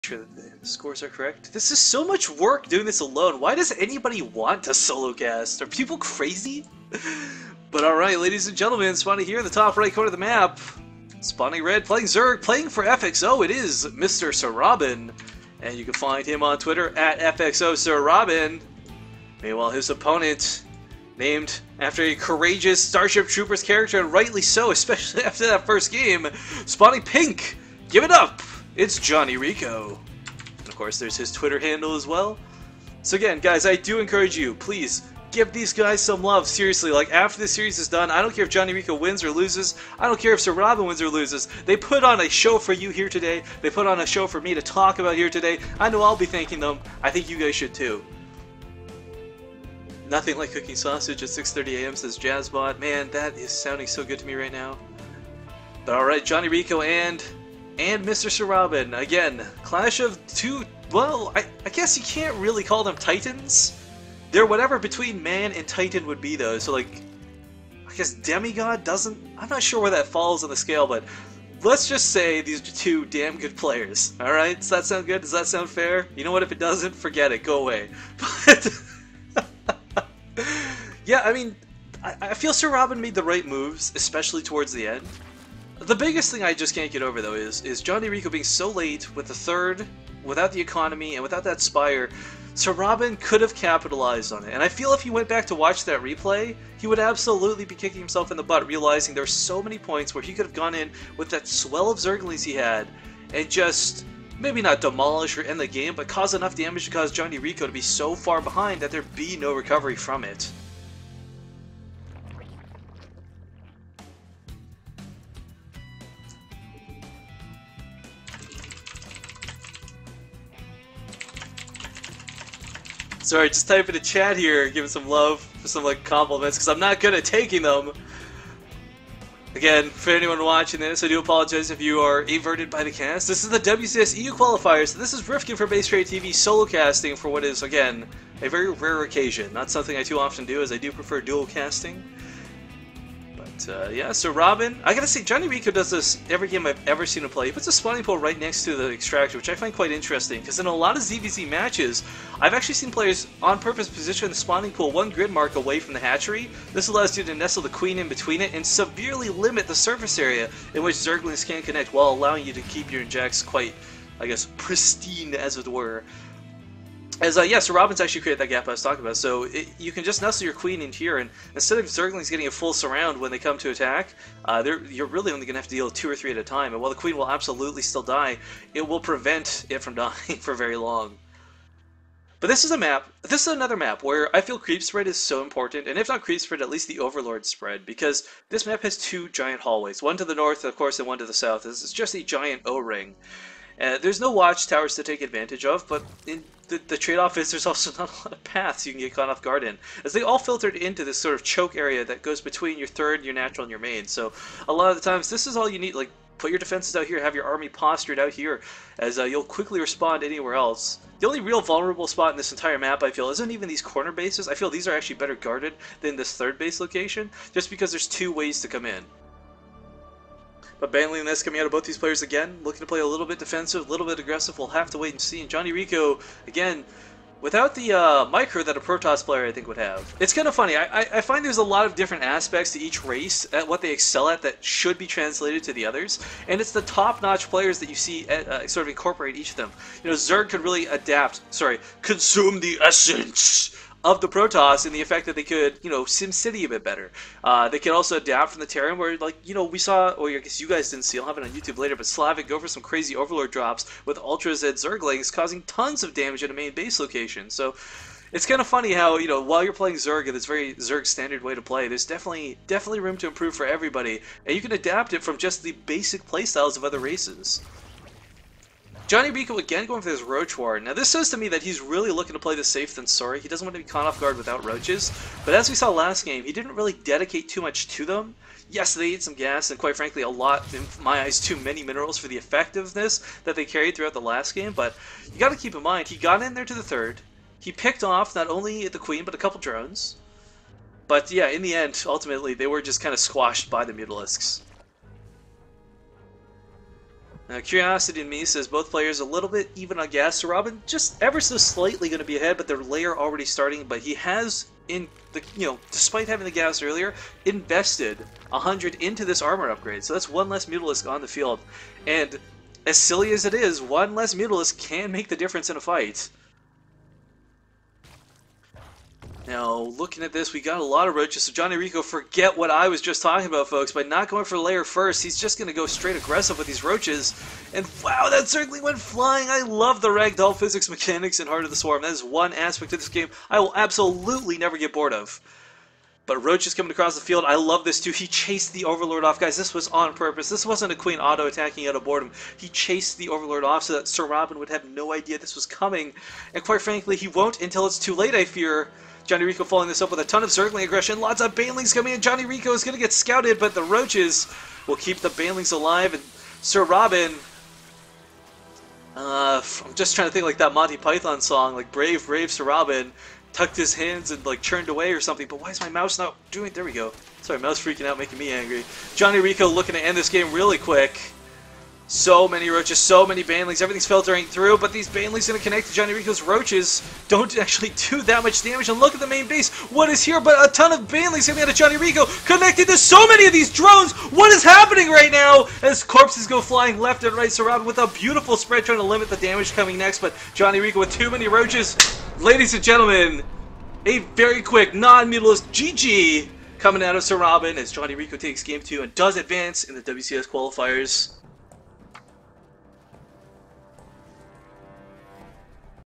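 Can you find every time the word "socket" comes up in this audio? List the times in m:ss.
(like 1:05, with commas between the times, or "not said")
not said.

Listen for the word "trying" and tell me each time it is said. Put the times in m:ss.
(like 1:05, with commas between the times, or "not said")
6:00, 6:28.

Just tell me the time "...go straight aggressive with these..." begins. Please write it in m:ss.
5:25.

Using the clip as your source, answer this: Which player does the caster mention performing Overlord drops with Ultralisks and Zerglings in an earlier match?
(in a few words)
Slavic.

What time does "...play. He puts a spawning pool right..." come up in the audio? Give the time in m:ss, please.
2:27.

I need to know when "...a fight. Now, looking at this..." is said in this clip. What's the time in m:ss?
5:15.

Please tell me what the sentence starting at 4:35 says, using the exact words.
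But as we saw last game, he didn't really dedicate too much to them.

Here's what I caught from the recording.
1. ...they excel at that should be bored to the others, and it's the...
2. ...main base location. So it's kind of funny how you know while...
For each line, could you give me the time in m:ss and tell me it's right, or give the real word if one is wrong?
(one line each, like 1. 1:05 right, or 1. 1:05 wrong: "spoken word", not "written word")
1. 3:53 wrong: "translated", not "bored"
2. 4:16 right.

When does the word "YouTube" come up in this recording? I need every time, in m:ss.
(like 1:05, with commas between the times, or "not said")
4:11.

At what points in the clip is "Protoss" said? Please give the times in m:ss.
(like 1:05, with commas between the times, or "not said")
3:48, 4:04.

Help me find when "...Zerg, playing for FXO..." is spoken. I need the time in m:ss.
0:12.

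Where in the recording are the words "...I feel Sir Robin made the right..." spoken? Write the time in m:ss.
1:22.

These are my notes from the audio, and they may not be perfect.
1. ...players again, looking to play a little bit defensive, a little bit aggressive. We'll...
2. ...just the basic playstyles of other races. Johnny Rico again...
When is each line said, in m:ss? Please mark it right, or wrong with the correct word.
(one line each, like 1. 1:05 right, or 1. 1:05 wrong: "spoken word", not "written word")
1. 3:41 right
2. 4:25 right.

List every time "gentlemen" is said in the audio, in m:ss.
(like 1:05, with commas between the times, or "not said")
0:08, 6:32.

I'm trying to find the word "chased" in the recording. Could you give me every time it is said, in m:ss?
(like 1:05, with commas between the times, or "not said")
5:38, 5:42.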